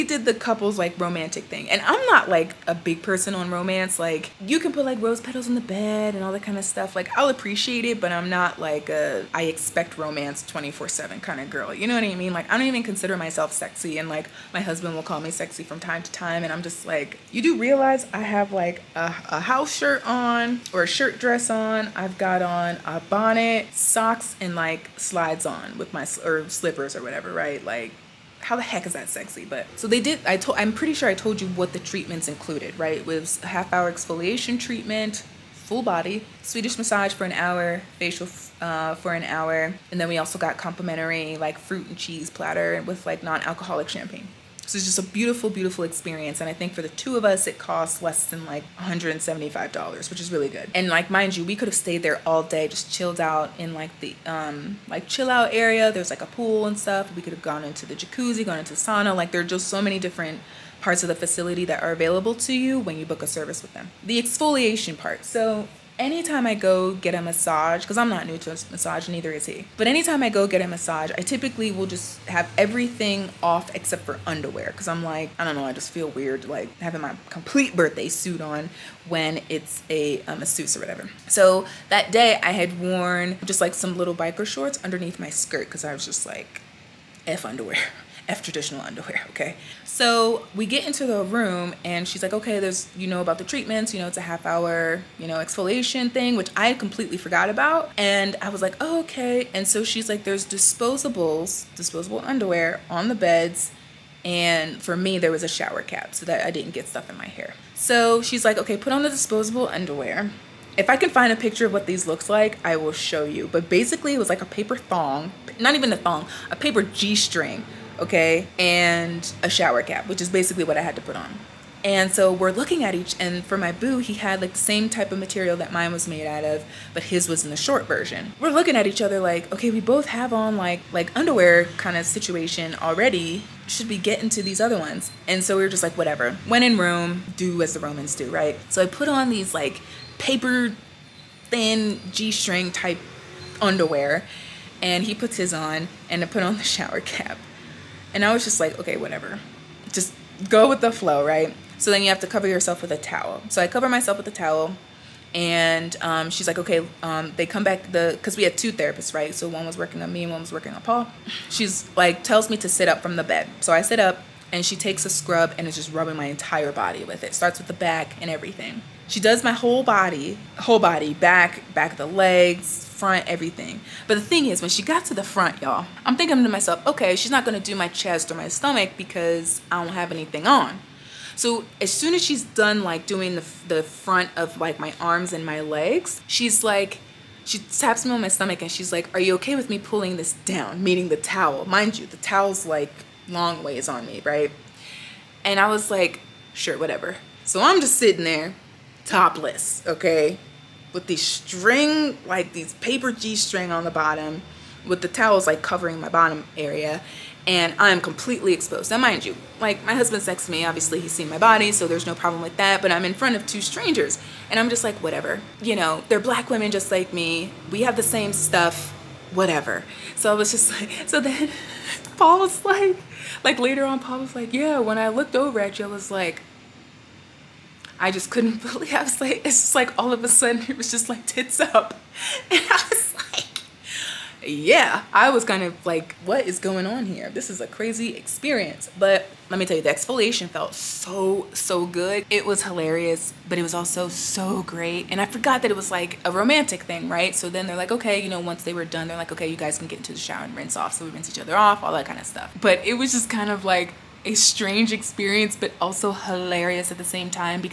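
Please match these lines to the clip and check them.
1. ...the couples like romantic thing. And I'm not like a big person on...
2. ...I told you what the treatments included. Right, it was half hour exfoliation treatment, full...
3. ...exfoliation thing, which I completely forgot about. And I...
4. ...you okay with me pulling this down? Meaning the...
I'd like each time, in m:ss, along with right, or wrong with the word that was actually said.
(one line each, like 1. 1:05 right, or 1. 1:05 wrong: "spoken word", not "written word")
1. 0:00 right
2. 0:31 right
3. 1:35 right
4. 3:09 right.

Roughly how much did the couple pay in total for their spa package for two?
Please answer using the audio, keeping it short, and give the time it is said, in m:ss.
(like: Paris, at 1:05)
Less than $175, at 0:48.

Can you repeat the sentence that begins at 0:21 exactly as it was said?
I've got on a bonnet, socks, and like slides on with my or slippers or whatever, right?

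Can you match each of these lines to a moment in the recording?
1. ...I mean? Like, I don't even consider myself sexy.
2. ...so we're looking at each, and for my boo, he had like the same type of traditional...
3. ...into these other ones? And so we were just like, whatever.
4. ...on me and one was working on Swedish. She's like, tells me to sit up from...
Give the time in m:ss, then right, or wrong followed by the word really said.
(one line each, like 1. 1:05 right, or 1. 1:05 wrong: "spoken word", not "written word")
1. 0:12 right
2. 2:02 wrong: "material", not "traditional"
3. 2:14 right
4. 2:40 wrong: "Paul", not "Swedish".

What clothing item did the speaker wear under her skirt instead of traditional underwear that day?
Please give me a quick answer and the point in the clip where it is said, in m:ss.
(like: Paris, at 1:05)
Biker shorts, at 1:24.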